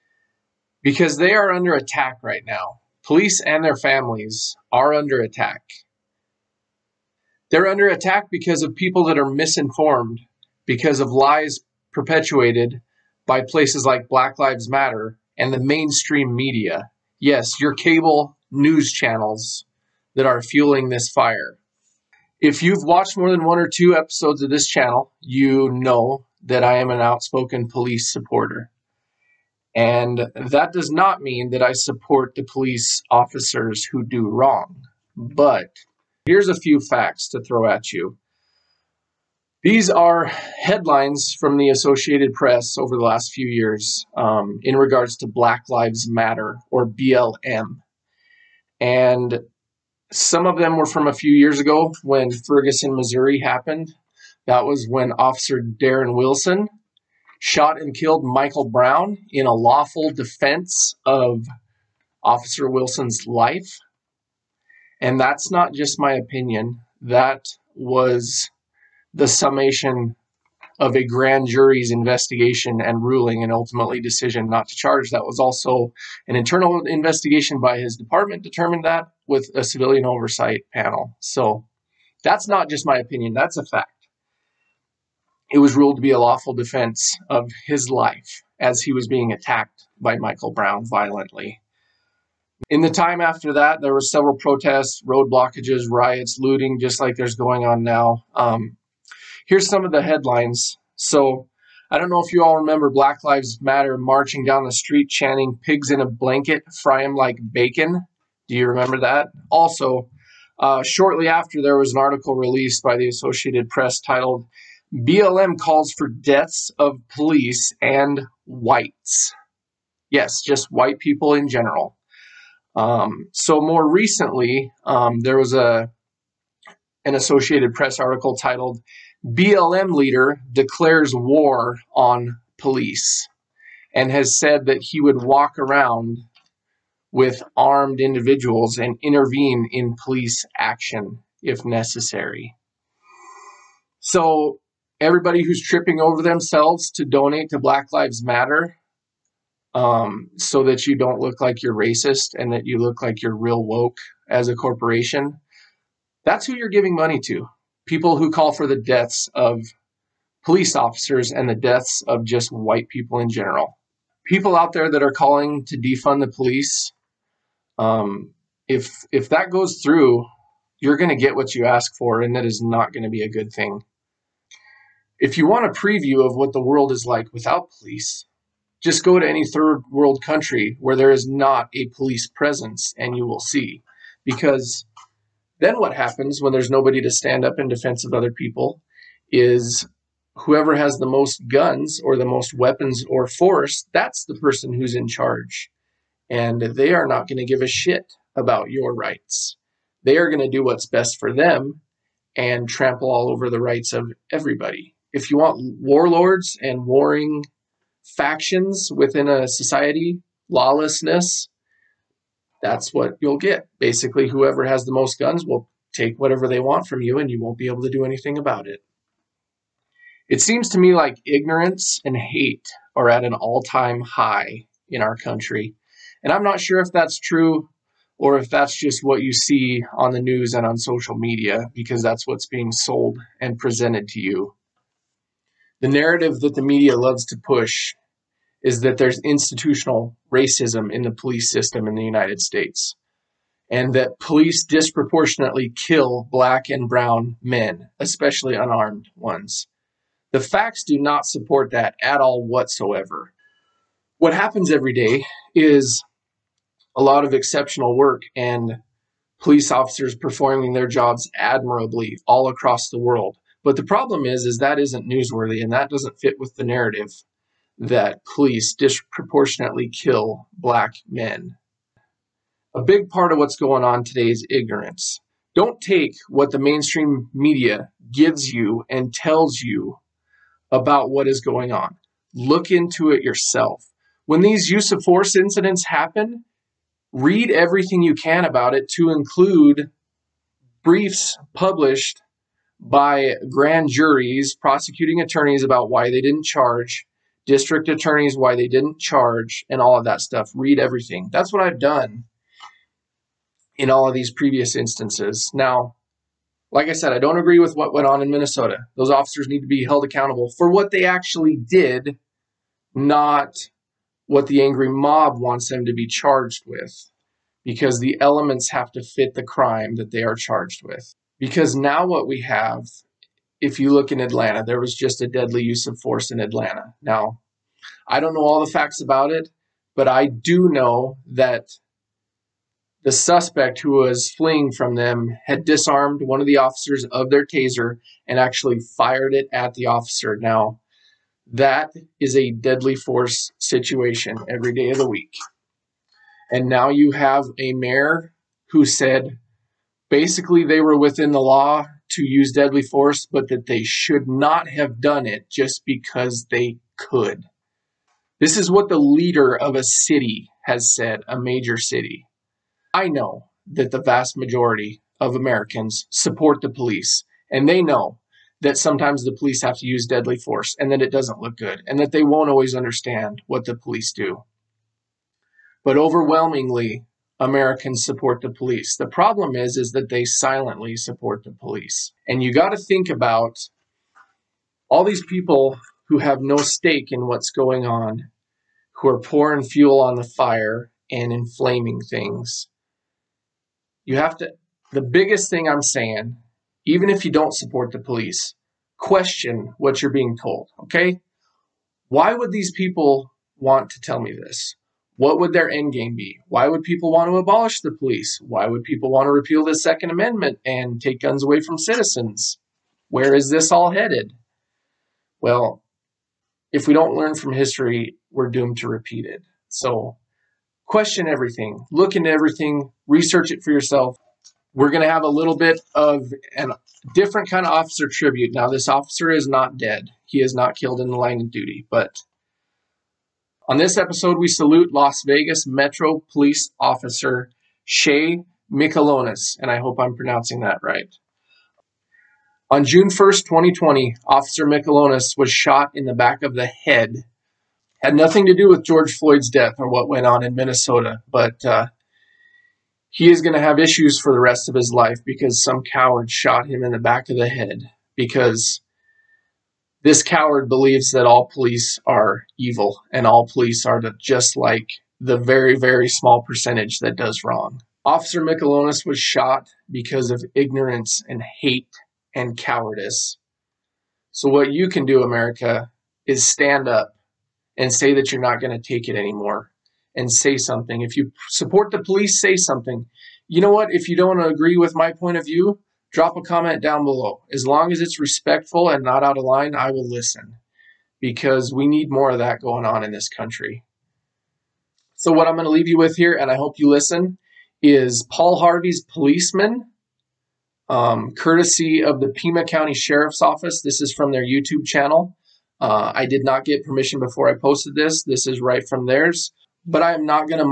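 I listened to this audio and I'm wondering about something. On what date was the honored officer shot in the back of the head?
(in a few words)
June 1, 2020.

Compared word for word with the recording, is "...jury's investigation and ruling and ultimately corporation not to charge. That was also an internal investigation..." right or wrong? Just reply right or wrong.
wrong.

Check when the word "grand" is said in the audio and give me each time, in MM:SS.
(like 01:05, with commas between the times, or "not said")
01:11, 04:53.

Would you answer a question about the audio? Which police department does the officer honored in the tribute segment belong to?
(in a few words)
Las Vegas Metro.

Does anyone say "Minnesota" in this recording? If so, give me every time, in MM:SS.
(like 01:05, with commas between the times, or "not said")
05:08, 07:30.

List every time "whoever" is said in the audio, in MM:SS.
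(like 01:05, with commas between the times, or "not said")
03:10, 03:34.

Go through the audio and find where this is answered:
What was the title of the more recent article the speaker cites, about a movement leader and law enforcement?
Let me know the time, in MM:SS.
02:09.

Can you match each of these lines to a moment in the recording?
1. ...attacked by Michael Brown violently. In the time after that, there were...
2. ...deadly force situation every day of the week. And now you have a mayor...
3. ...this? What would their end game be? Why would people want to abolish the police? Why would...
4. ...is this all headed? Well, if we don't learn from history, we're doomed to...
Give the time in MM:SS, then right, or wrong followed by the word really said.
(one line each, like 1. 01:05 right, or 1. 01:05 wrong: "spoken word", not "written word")
1. 01:29 right
2. 05:42 right
3. 06:44 right
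4. 06:53 right.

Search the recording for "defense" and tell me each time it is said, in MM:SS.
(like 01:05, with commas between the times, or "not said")
01:00, 01:26, 03:07.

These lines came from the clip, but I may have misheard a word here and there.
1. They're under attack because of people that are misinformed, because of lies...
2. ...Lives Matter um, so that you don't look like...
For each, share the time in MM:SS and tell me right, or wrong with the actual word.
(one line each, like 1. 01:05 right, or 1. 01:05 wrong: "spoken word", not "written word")
1. 00:07 right
2. 02:27 right.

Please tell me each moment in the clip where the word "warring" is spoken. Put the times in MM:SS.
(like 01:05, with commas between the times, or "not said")
03:26.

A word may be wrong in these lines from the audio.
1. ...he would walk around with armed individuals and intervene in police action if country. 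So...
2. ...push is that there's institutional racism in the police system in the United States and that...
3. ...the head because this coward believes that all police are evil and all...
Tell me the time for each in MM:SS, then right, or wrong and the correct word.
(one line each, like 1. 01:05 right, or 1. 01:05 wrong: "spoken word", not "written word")
1. 02:14 wrong: "necessary", not "country"
2. 03:57 right
3. 07:37 right.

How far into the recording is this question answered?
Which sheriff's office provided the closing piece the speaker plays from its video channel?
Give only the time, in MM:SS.
08:22.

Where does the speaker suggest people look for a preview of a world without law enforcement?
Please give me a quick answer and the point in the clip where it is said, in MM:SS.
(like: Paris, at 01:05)
Third world country, at 02:59.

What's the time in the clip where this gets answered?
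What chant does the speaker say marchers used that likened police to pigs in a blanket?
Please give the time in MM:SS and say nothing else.
01:46.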